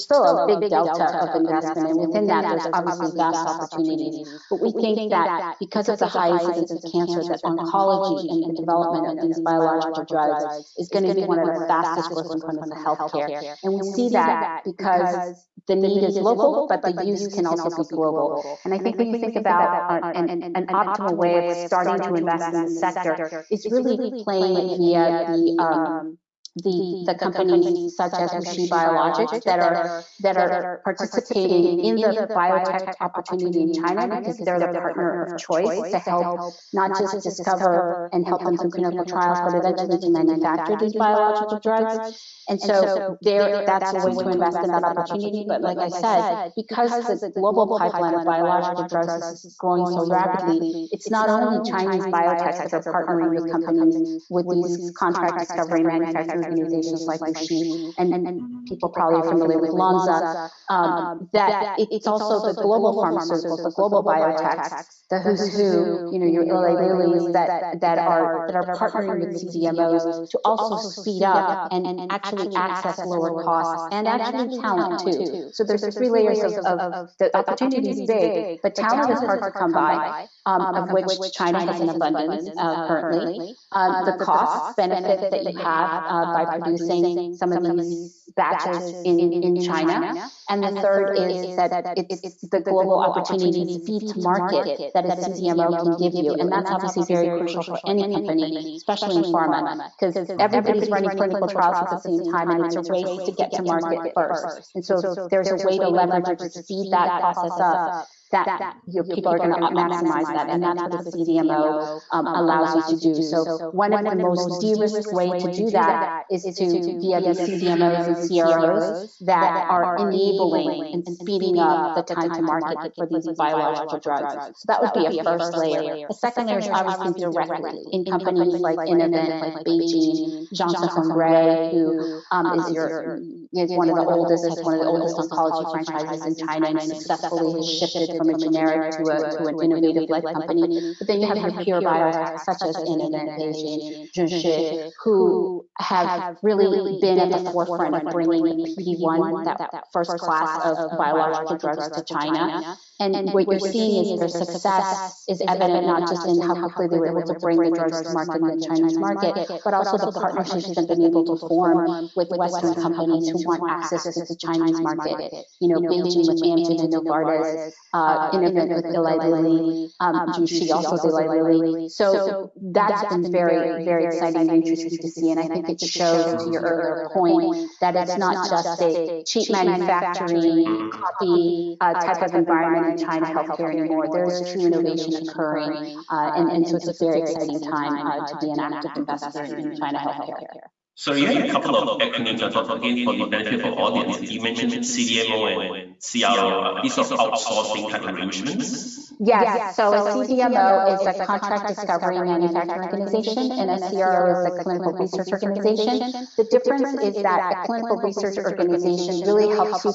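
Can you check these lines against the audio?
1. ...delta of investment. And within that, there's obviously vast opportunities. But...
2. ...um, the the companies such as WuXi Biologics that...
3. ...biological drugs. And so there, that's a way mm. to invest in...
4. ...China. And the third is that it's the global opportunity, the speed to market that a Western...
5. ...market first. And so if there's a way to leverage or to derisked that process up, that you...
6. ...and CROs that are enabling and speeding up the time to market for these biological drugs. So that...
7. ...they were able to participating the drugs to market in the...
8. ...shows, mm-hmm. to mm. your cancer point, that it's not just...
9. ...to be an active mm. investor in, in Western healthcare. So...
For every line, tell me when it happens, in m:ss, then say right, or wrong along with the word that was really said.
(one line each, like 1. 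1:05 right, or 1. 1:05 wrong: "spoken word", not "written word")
1. 0:00 right
2. 0:25 right
3. 0:40 right
4. 1:29 wrong: "CDMO", not "Western"
5. 1:43 wrong: "speed", not "derisked"
6. 1:58 right
7. 2:36 wrong: "bring", not "participating"
8. 2:55 wrong: "earlier", not "cancer"
9. 3:08 wrong: "China", not "Western".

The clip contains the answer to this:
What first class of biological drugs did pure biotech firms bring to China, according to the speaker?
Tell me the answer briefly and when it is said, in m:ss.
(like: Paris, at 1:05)
PD-1, at 2:28.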